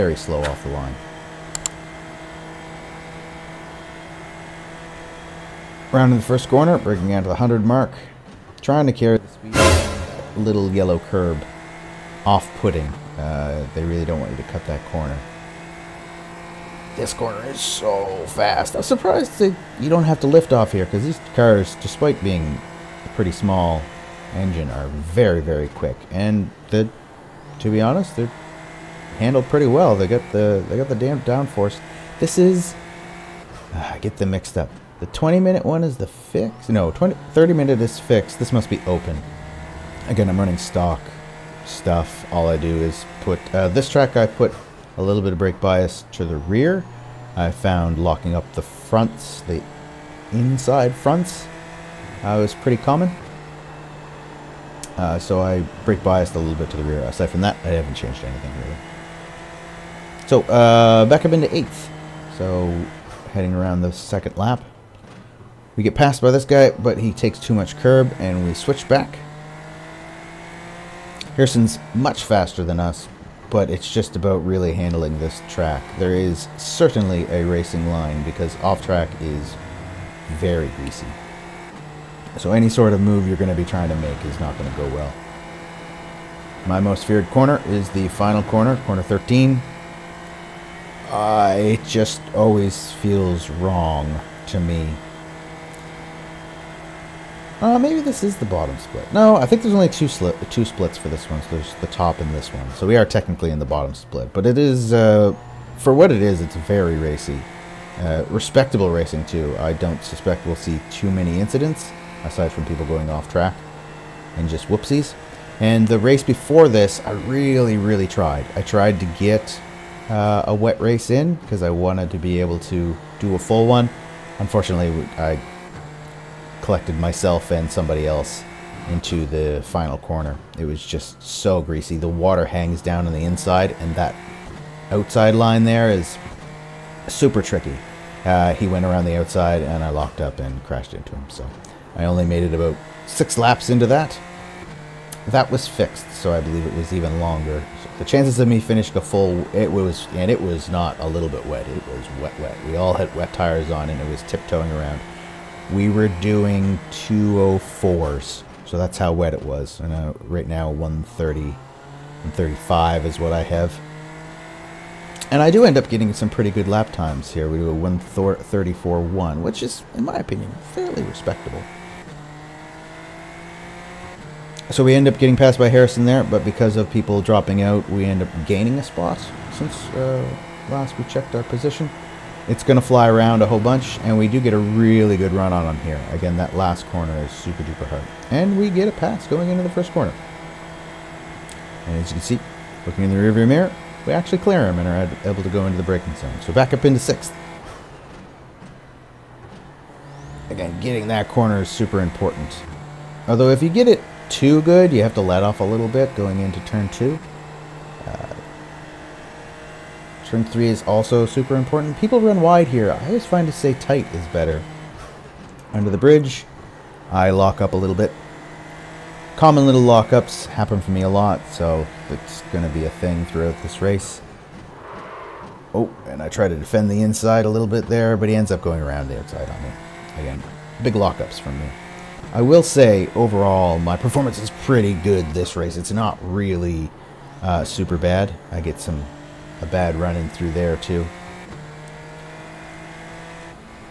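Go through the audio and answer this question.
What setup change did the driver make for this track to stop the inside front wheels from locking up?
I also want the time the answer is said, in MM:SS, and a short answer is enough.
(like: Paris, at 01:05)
Brake bias to the rear, at 00:45.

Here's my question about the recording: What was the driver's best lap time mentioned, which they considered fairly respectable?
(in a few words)
1:34.1.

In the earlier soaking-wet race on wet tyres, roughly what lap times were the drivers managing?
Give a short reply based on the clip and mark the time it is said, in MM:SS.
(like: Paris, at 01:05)
2:04, at 02:36.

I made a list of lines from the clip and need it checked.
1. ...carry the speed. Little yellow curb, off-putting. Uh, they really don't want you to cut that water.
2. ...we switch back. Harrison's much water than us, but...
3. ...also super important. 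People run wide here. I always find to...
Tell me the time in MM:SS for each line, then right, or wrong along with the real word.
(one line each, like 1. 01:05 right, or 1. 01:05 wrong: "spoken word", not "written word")
1. 00:08 wrong: "corner", not "water"
2. 01:08 wrong: "faster", not "water"
3. 03:30 right.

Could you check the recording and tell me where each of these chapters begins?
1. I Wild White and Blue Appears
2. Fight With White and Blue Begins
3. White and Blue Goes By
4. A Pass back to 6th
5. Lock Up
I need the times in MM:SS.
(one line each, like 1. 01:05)
1. 00:06
2. 00:49
3. 02:41
4. 03:18
5. 03:43.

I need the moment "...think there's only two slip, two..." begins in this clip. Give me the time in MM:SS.
01:39.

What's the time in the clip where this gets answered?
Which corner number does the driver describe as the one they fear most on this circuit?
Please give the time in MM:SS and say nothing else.
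01:28.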